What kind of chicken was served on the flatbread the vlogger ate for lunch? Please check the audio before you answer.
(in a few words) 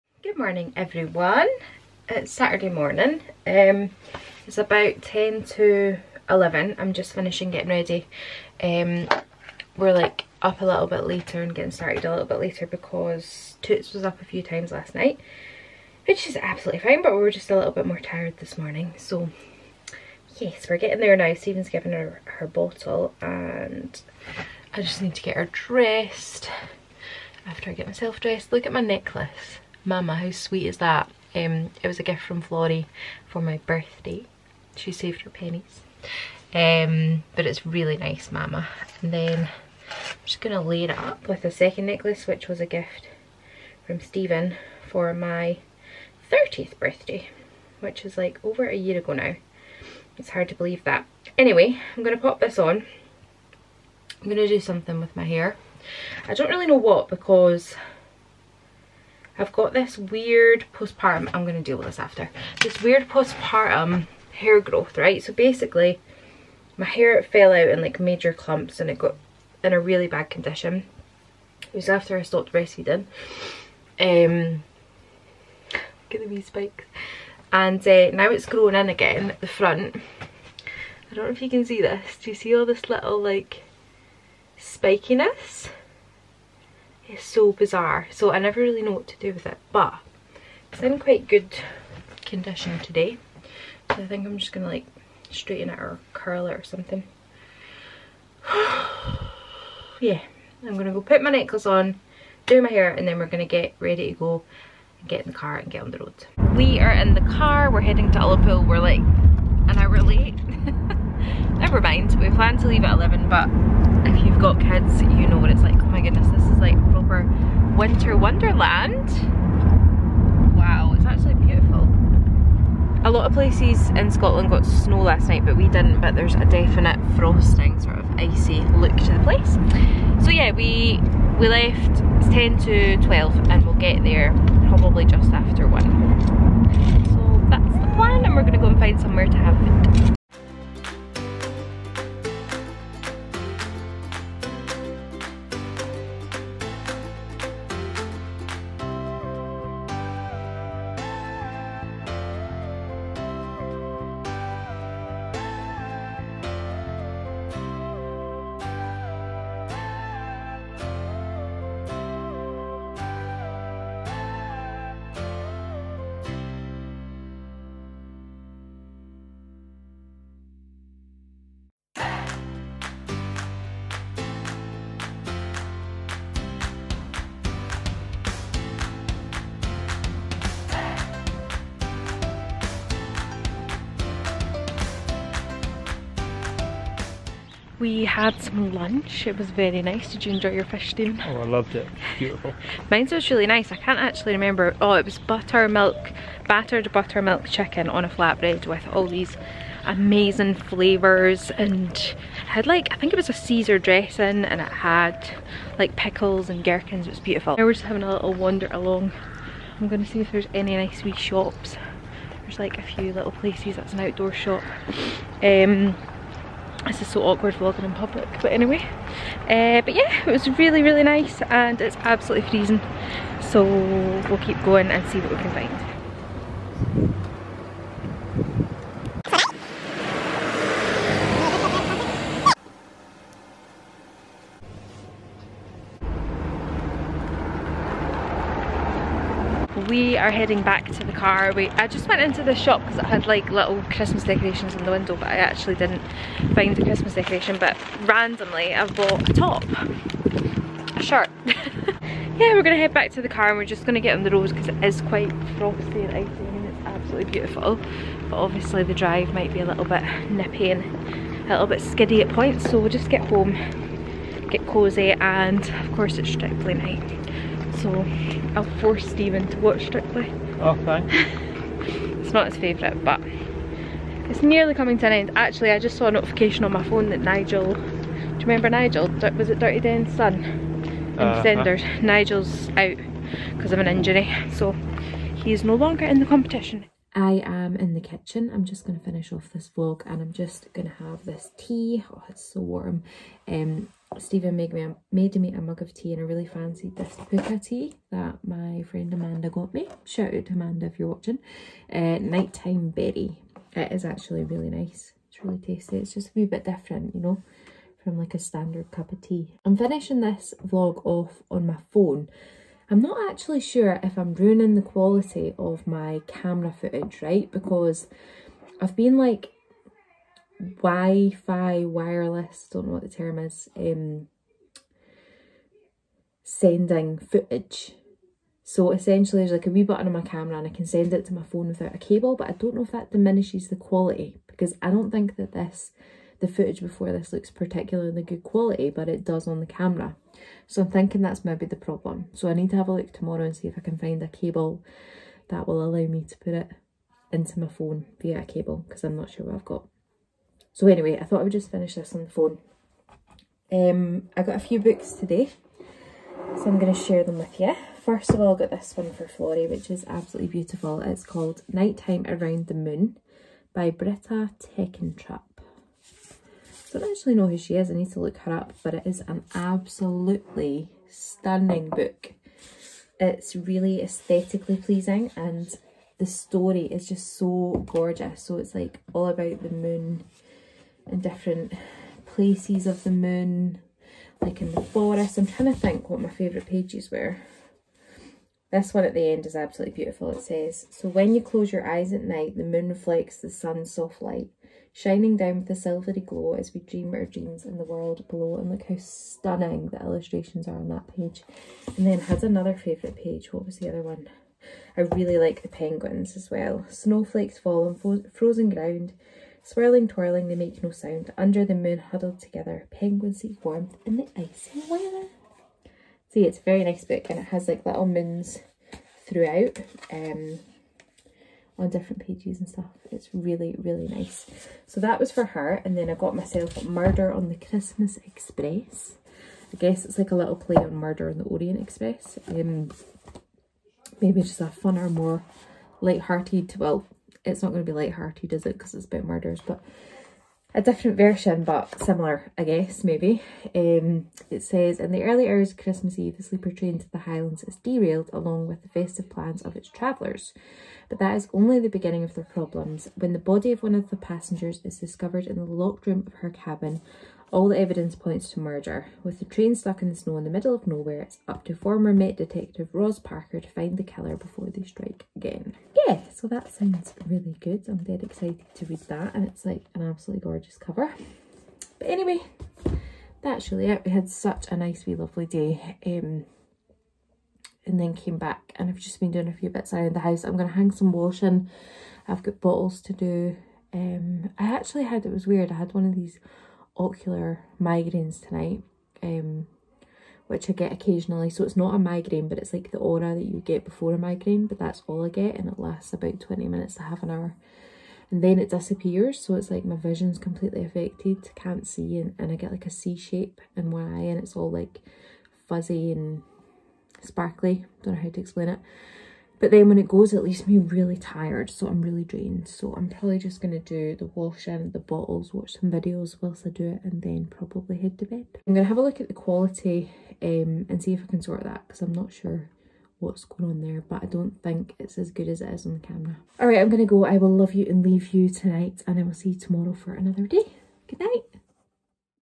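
battered buttermilk chicken.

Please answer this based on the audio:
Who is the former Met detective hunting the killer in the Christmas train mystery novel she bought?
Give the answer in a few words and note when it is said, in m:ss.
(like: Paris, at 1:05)
Roz Parker, at 7:42.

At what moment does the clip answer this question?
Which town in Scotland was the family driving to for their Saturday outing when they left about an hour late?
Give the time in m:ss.
1:48.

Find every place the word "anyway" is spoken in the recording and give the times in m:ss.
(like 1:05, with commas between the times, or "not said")
0:51, 3:38, 5:50, 7:52.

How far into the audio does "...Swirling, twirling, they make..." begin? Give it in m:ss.
6:49.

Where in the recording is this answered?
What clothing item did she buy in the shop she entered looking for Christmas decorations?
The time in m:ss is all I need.
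4:10.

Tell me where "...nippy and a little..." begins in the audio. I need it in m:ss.
4:20.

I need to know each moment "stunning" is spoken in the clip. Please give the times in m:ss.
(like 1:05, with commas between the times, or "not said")
6:11, 6:38.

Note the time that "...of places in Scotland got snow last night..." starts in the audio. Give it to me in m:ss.
2:03.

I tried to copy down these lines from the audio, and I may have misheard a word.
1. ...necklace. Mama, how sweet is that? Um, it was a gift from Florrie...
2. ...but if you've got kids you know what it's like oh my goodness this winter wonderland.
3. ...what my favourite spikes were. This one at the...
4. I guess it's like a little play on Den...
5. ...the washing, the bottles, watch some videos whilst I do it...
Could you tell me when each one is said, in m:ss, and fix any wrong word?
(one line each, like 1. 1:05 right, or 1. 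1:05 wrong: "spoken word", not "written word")
1. 0:28 right
2. 1:53 right
3. 6:26 wrong: "pages", not "spikes"
4. 7:09 wrong: "Murder", not "Den"
5. 8:34 right.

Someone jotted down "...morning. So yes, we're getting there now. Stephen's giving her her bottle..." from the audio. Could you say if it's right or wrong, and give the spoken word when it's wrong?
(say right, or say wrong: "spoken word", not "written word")
right.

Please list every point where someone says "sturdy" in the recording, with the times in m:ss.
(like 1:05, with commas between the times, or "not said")
not said.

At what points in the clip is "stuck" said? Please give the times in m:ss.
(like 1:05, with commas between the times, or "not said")
7:39.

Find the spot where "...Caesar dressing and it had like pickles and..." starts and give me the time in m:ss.
3:23.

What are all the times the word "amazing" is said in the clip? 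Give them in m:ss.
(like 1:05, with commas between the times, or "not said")
3:19.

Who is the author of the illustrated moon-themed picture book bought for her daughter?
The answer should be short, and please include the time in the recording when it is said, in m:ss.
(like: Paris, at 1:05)
Britta Teckentrup, at 6:03.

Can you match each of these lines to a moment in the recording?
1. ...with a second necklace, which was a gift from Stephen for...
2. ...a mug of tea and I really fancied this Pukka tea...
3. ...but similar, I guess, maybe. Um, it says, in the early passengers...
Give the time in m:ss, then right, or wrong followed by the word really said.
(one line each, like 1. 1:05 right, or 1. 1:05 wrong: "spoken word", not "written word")
1. 0:41 right
2. 4:55 right
3. 7:21 wrong: "hours", not "passengers".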